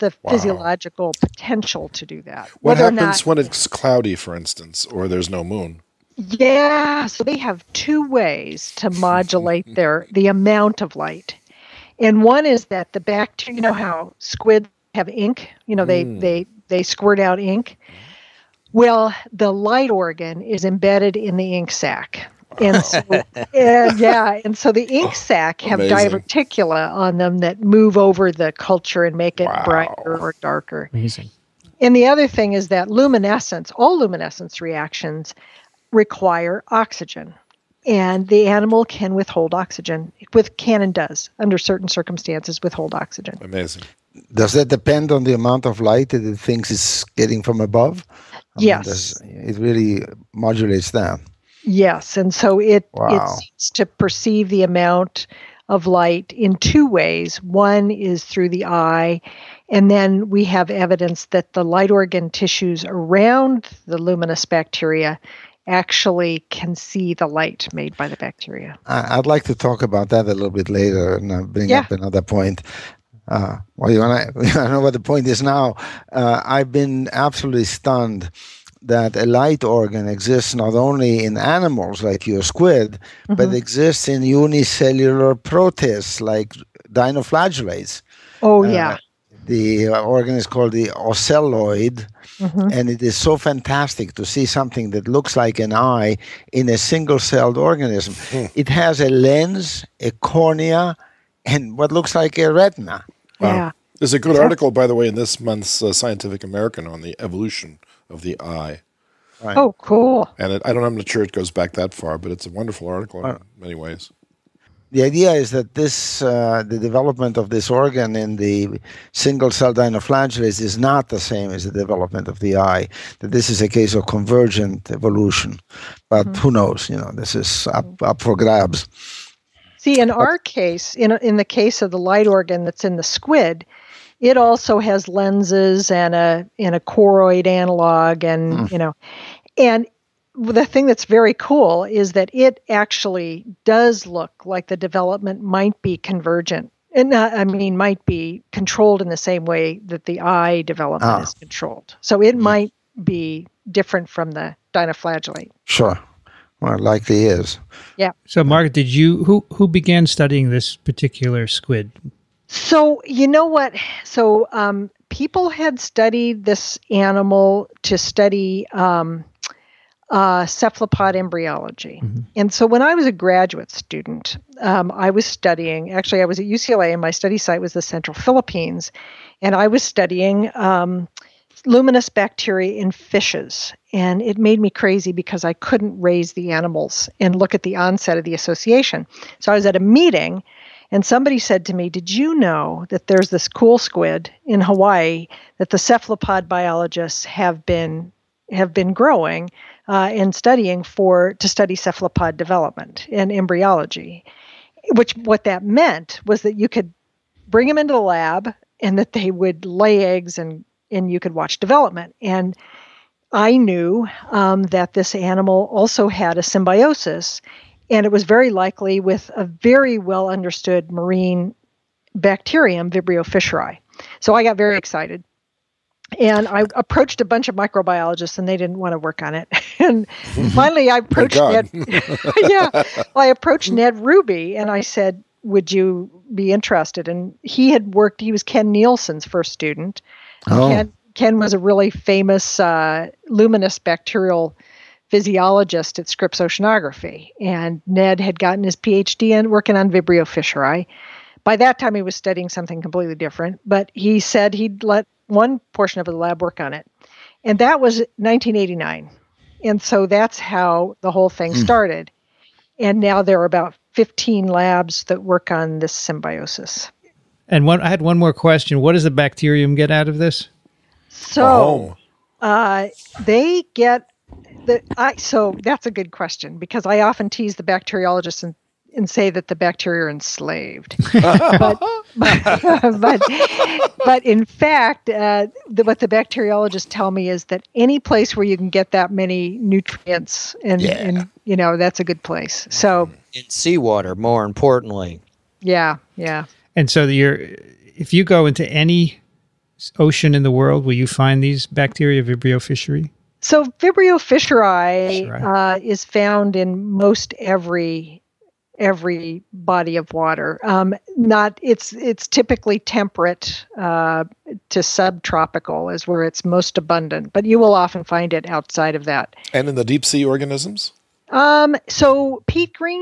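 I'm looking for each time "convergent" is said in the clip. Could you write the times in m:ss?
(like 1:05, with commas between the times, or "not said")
2:04, 2:25.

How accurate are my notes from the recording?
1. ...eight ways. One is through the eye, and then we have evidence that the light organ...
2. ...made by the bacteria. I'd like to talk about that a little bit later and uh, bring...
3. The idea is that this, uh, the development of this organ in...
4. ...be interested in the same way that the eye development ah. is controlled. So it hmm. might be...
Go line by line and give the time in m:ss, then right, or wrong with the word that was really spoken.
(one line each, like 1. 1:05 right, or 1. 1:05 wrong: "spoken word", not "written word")
1. 0:56 wrong: "two", not "eight"
2. 1:07 right
3. 1:54 right
4. 2:28 wrong: "controlled", not "interested".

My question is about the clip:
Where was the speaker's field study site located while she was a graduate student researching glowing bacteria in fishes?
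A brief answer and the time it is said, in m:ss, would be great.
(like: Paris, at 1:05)
Central Philippines, at 2:57.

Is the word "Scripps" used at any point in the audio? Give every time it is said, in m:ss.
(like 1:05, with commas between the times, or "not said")
4:06.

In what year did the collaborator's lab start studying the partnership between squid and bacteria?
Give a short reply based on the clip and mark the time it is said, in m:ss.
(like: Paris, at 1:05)
1989, at 4:17.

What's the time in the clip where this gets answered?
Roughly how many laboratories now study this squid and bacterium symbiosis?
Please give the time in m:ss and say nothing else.
4:23.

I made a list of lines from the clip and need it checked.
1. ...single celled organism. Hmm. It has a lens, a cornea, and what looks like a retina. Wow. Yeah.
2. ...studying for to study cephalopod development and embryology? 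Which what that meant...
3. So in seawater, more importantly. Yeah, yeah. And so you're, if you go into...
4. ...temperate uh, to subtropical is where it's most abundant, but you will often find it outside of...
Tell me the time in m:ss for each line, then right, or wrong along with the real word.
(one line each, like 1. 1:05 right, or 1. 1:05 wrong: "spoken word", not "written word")
1. 1:36 right
2. 3:20 right
3. 4:52 right
4. 5:12 right.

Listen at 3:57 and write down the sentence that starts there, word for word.
And he had worked, he was Ken Nealson's first student.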